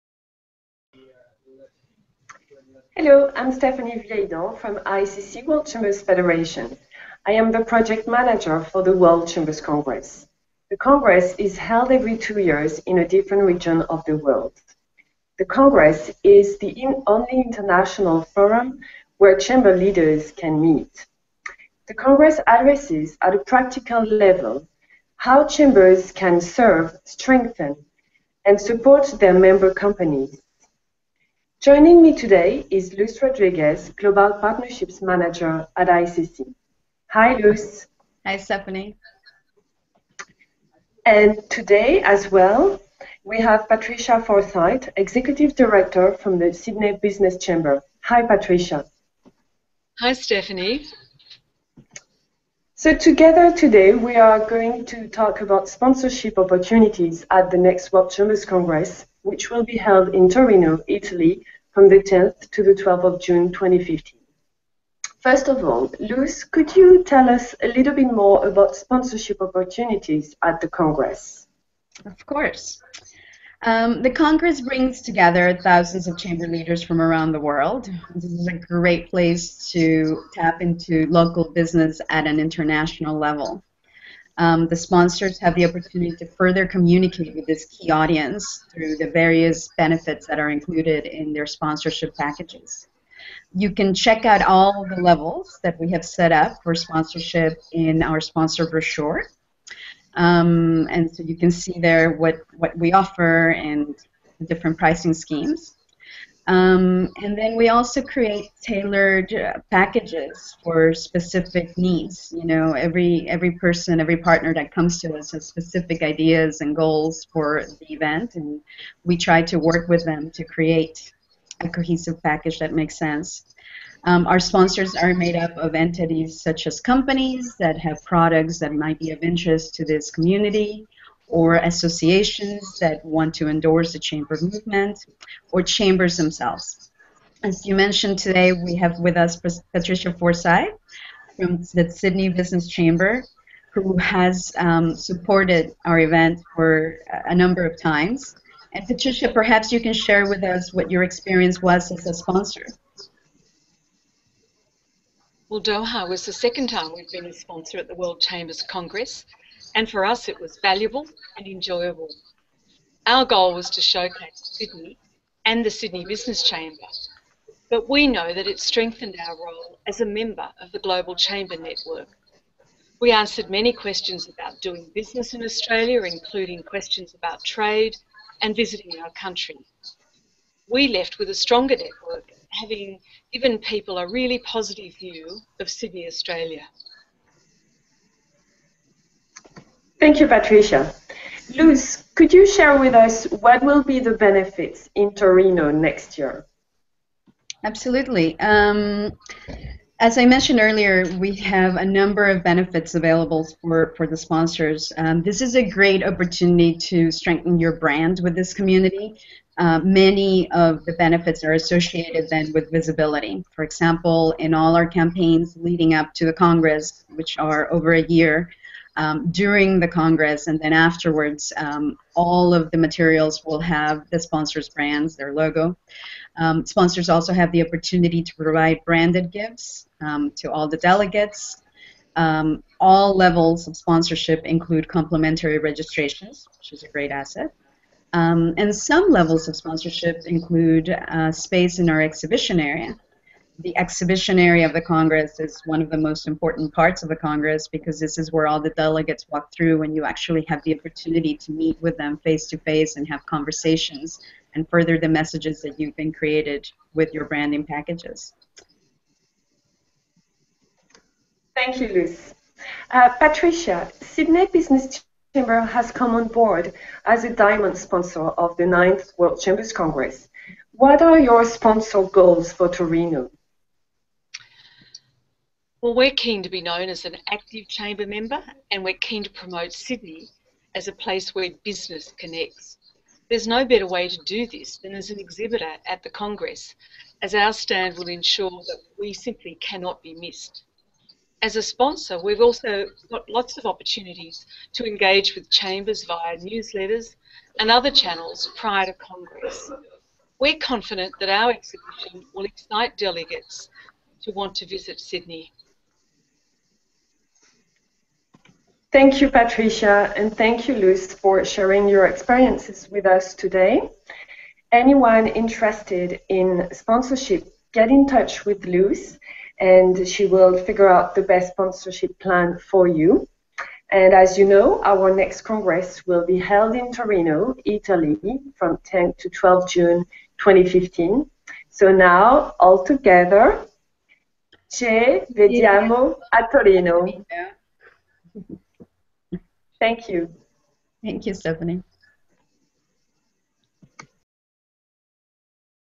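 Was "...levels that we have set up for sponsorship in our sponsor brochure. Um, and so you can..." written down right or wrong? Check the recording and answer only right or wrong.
right.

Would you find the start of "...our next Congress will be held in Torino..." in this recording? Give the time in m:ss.
5:24.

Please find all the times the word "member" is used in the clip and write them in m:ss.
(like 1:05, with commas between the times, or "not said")
0:29, 2:50, 4:38.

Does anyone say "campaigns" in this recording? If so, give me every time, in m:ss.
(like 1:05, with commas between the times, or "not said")
3:34.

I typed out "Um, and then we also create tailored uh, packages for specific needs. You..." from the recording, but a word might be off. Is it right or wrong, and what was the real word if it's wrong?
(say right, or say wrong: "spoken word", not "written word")
right.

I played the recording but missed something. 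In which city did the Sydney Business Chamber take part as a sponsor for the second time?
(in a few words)
Doha.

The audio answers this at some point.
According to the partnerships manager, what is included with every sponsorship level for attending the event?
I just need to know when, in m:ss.
3:54.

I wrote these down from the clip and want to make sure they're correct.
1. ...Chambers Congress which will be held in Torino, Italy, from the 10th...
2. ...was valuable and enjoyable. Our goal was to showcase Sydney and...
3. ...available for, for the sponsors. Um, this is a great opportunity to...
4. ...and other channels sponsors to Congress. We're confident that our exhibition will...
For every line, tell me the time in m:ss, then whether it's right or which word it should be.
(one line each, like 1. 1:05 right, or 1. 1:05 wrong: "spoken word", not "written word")
1. 0:58 right
2. 2:40 right
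3. 3:22 right
4. 4:57 wrong: "prior", not "sponsors".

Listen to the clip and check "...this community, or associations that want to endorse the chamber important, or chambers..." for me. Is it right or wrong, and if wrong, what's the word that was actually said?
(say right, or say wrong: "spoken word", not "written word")
wrong: "movement", not "important".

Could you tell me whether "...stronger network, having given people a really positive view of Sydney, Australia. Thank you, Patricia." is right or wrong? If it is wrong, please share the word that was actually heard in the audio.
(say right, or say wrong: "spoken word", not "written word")
right.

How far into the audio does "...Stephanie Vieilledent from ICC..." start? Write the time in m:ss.
0:03.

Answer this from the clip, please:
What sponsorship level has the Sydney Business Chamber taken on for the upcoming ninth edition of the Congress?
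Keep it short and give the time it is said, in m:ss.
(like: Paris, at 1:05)
Diamond, at 4:27.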